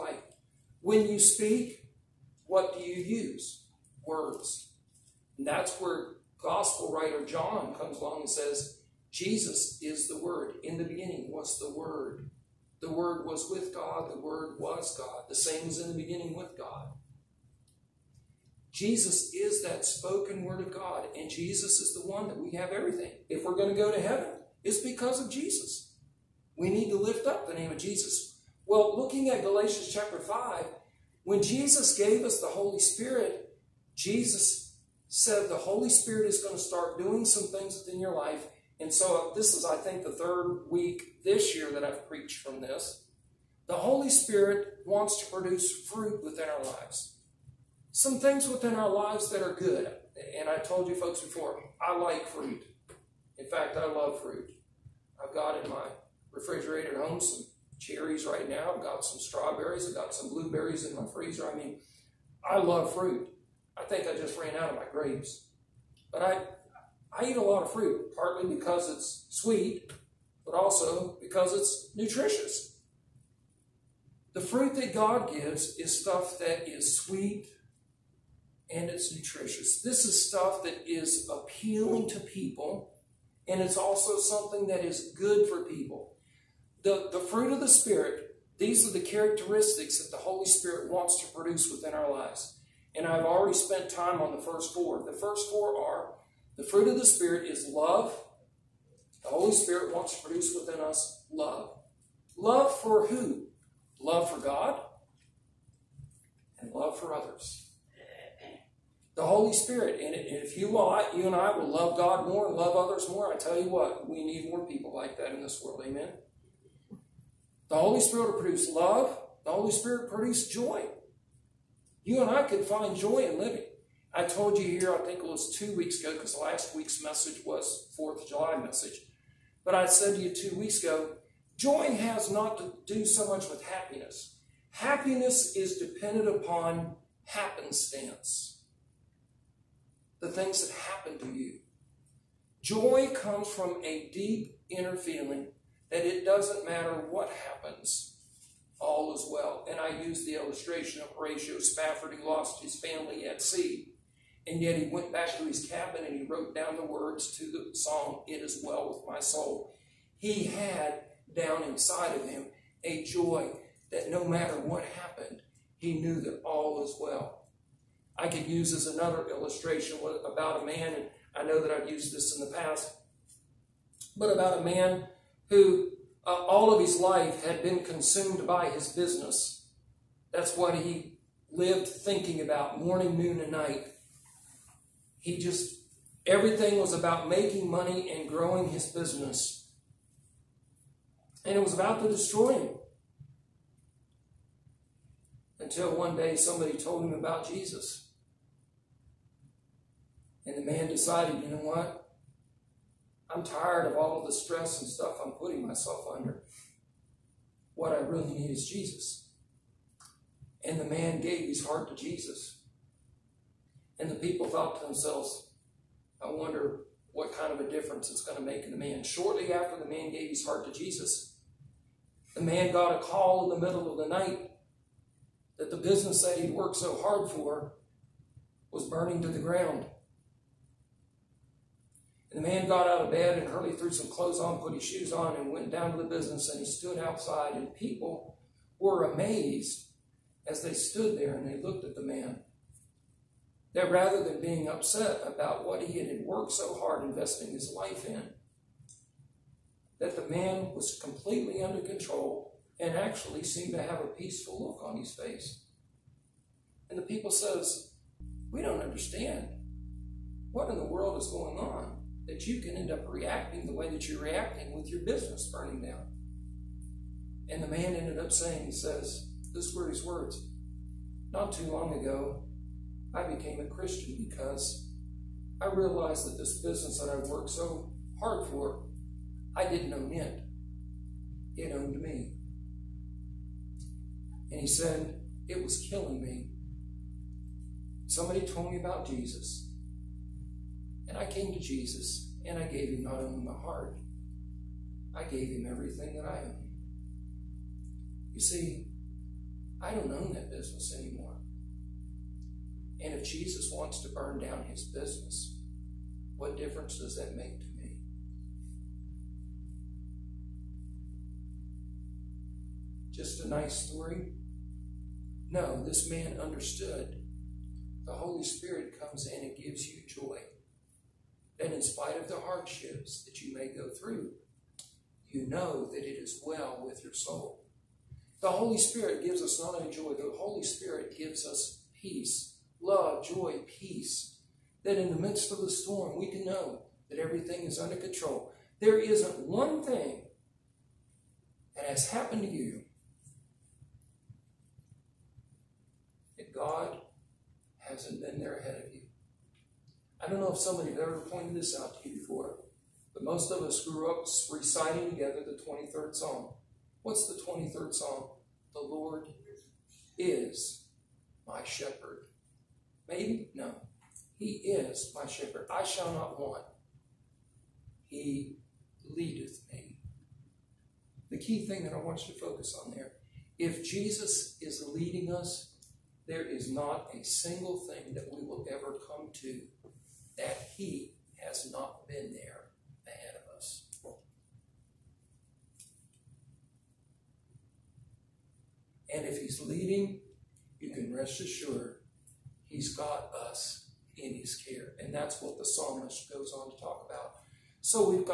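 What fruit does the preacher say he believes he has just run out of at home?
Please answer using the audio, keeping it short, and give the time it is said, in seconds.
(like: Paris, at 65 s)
Grapes, at 64 s.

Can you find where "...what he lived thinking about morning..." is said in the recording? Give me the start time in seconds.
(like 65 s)
180 s.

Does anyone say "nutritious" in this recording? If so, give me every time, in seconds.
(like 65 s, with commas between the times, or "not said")
71 s, 79 s.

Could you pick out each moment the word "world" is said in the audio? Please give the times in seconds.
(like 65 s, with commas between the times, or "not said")
115 s, 260 s.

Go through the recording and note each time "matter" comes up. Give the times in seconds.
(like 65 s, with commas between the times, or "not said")
146 s, 164 s.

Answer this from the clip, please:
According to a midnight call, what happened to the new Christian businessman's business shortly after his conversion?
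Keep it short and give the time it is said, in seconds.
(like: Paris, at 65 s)
Burning to the ground, at 228 s.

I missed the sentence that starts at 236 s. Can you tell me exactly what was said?
And he stood outside, and people were amazed as they stood there and they looked at the man.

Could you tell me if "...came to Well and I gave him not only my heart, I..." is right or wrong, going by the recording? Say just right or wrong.
wrong.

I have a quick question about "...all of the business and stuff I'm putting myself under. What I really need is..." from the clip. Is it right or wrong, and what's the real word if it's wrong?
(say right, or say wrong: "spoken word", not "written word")
wrong: "stress", not "business".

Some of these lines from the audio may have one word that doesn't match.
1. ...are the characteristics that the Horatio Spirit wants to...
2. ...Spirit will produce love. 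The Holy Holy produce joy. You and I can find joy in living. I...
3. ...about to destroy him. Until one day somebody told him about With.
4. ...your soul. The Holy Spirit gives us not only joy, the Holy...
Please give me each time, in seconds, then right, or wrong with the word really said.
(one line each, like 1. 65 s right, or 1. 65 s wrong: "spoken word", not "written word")
1. 88 s wrong: "Holy", not "Horatio"
2. 118 s wrong: "Spirit", not "Holy"
3. 191 s wrong: "Jesus", not "With"
4. 327 s right.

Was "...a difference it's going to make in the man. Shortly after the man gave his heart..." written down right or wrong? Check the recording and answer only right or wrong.
right.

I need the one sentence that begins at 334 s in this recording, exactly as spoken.
That in the midst of the storm, we can know that everything is under control.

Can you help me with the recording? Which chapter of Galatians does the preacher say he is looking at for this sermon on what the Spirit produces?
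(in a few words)
Chapter 5.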